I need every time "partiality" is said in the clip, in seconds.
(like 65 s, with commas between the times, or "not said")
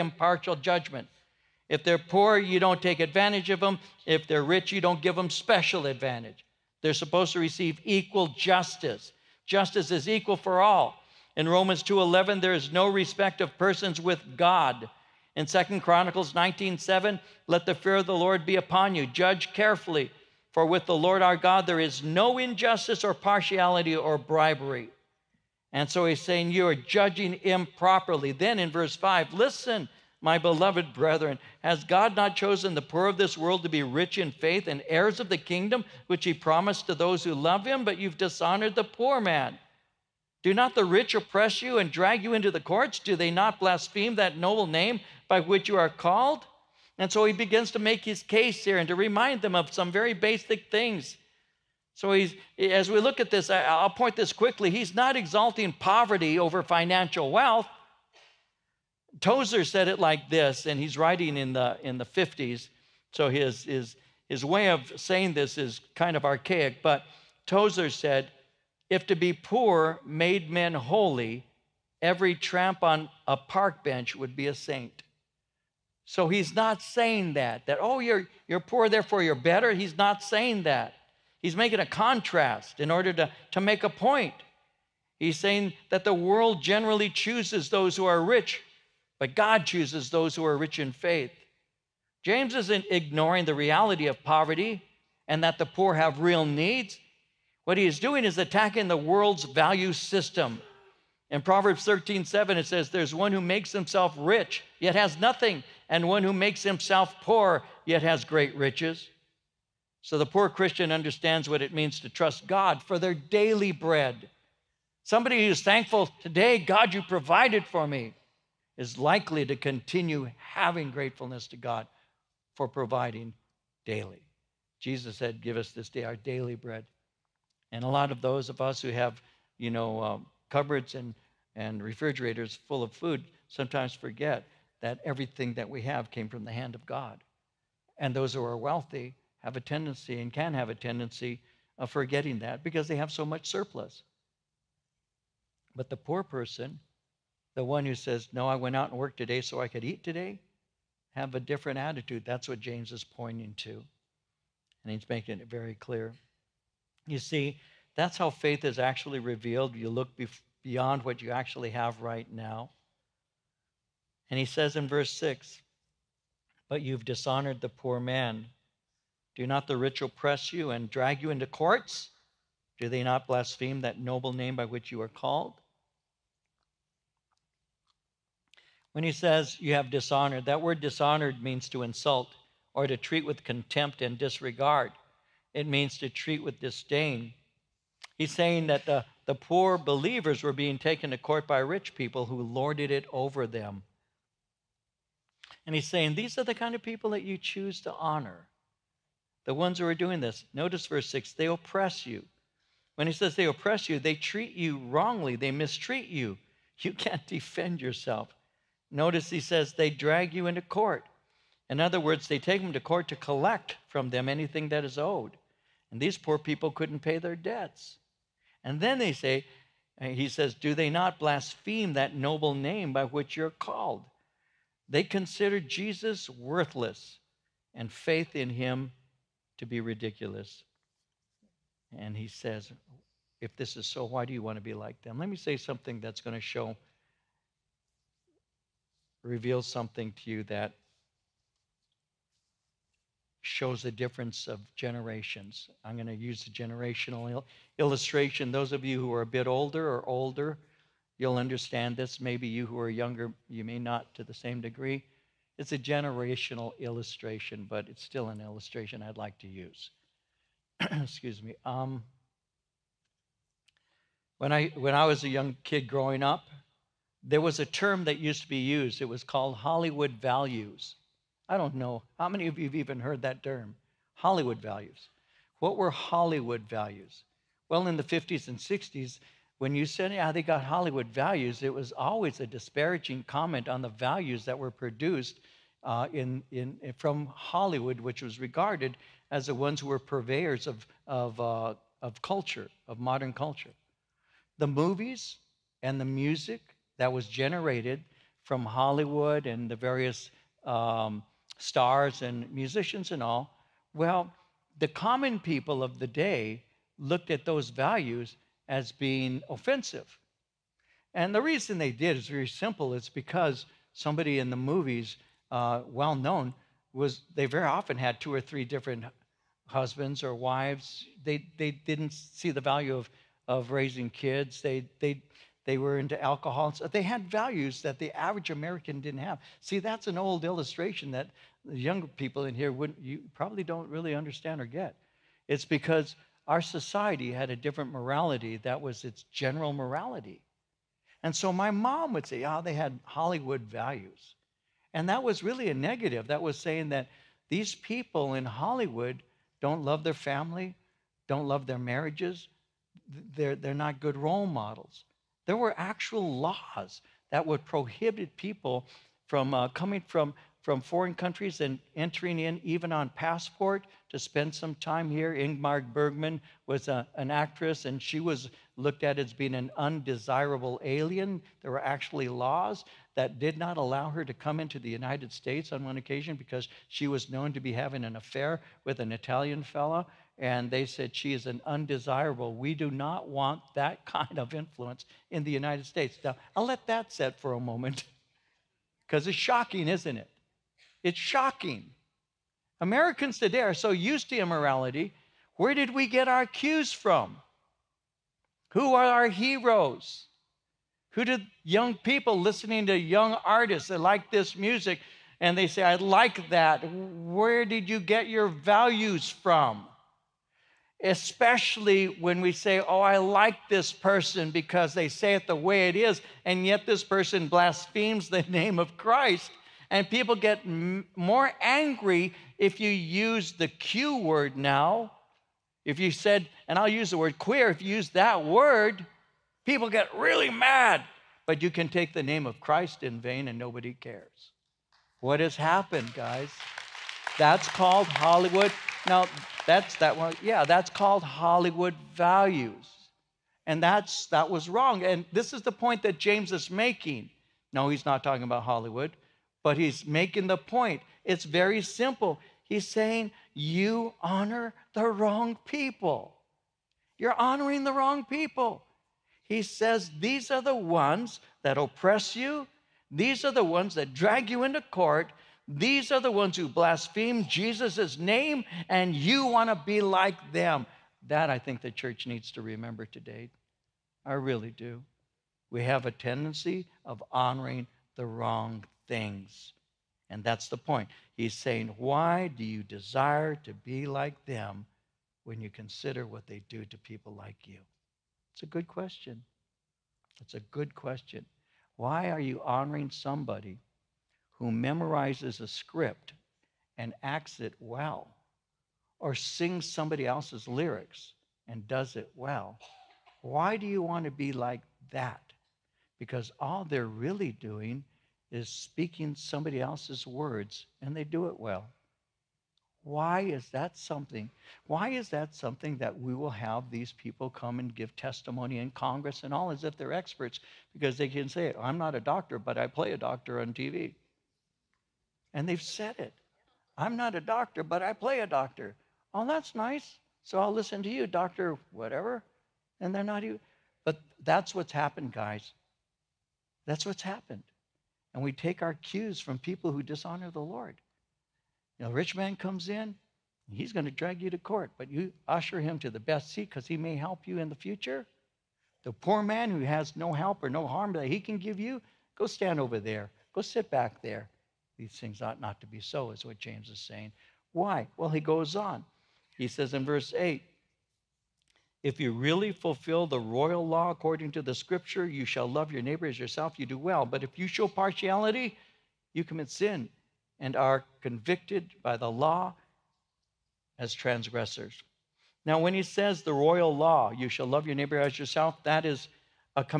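23 s, 567 s.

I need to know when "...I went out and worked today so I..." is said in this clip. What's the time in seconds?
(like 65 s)
148 s.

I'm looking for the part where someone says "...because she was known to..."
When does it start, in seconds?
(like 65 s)
376 s.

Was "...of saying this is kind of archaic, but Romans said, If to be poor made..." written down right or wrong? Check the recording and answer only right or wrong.
wrong.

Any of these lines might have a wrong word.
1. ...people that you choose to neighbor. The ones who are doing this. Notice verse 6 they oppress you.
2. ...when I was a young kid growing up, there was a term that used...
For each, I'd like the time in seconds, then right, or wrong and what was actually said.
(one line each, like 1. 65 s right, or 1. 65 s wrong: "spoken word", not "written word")
1. 196 s wrong: "honor", not "neighbor"
2. 264 s right.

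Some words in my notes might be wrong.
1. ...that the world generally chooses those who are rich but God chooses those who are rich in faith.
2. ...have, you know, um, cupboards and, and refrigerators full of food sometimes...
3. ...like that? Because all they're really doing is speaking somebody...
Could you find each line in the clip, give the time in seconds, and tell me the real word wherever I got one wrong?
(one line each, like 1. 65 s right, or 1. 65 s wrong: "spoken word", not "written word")
1. 85 s right
2. 128 s right
3. 504 s right.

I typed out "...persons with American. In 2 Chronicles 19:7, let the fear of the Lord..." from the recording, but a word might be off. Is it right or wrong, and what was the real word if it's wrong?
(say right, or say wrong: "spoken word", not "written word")
wrong: "God", not "American".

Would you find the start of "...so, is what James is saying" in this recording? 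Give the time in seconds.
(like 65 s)
555 s.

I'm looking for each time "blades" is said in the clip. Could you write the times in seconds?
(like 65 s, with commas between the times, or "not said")
not said.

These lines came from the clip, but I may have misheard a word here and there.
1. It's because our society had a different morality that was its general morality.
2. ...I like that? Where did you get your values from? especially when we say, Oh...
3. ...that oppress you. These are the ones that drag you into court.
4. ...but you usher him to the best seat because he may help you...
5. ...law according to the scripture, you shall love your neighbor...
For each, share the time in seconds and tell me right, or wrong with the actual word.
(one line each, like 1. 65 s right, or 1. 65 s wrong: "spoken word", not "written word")
1. 335 s right
2. 405 s right
3. 461 s right
4. 544 s right
5. 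563 s right.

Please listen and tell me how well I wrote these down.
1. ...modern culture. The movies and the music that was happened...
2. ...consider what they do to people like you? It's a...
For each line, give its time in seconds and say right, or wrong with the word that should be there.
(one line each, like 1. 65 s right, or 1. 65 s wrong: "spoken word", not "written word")
1. 292 s wrong: "generated", not "happened"
2. 485 s right.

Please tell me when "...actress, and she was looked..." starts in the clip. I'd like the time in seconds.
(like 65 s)
367 s.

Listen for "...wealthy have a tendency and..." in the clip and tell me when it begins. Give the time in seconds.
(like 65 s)
138 s.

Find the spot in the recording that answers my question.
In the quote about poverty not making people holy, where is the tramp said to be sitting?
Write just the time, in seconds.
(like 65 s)
73 s.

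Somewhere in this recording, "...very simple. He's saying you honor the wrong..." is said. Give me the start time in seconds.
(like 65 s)
451 s.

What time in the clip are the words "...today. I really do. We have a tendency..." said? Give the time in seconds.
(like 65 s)
473 s.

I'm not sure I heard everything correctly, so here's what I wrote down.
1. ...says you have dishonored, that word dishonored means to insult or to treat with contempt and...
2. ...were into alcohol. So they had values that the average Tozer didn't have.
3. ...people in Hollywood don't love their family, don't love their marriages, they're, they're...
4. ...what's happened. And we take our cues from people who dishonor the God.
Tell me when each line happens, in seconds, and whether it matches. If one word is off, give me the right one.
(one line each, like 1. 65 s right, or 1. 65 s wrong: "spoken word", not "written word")
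1. 179 s right
2. 325 s wrong: "American", not "Tozer"
3. 347 s right
4. 537 s wrong: "Lord", not "God".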